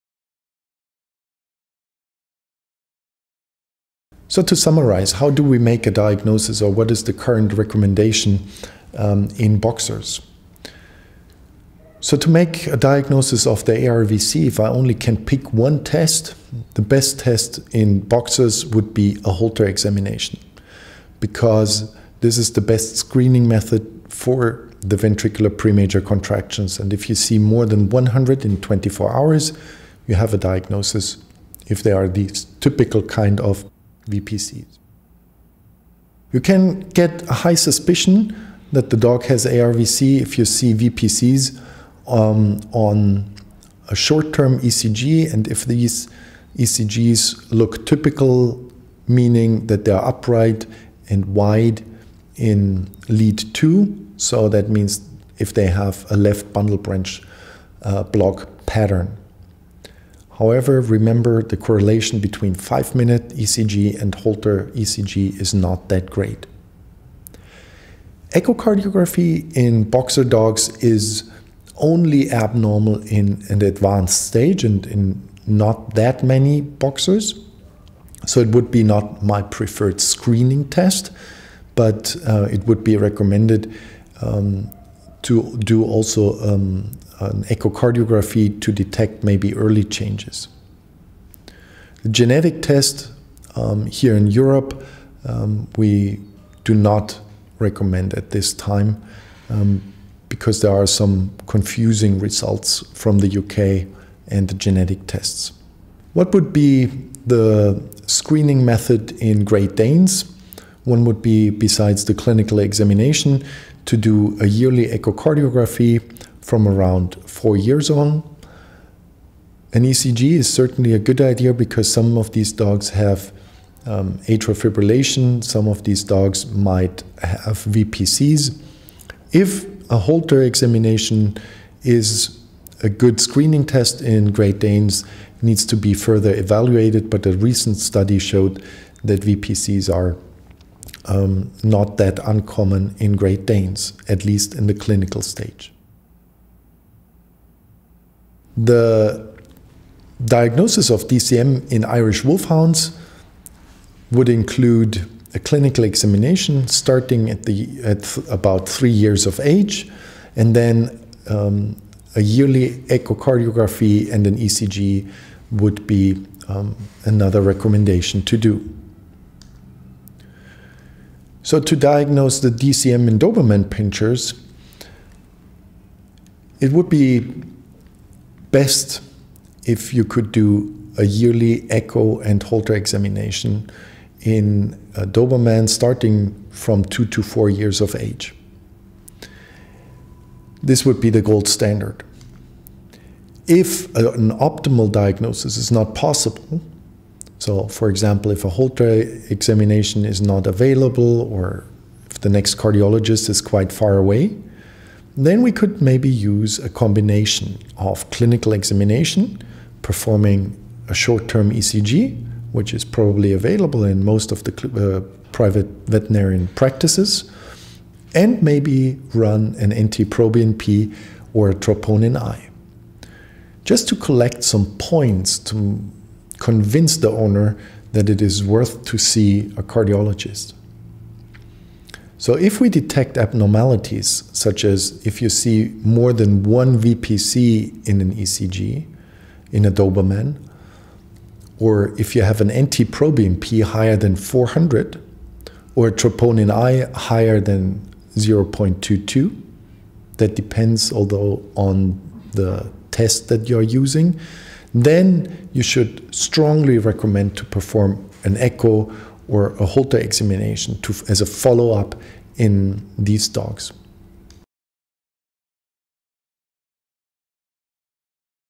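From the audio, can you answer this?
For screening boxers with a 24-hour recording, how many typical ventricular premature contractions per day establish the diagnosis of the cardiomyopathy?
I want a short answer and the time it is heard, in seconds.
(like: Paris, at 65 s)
more than 100, at 27 s.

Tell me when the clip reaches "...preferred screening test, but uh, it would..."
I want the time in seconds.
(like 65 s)
79 s.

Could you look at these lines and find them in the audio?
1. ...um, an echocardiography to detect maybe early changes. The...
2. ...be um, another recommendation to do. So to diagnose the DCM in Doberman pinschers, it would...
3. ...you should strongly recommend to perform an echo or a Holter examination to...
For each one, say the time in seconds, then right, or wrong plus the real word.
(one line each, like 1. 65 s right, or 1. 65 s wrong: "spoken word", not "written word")
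1. 86 s right
2. 165 s right
3. 255 s right.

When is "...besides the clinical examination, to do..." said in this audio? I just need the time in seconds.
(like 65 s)
111 s.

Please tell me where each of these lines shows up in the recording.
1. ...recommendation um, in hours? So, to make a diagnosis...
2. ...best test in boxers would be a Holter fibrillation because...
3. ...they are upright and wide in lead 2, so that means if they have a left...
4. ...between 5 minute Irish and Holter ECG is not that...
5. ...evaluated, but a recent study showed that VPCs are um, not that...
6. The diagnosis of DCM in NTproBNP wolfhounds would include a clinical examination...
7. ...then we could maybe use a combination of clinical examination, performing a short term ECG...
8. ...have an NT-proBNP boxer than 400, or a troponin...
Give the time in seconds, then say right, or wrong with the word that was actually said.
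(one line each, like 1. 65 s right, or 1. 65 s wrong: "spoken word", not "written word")
1. 7 s wrong: "boxers", not "hours"
2. 16 s wrong: "examination", not "fibrillation"
3. 49 s right
4. 62 s wrong: "ECG", not "Irish"
5. 136 s right
6. 148 s wrong: "Irish", not "NTproBNP"
7. 205 s right
8. 242 s wrong: "higher", not "boxer".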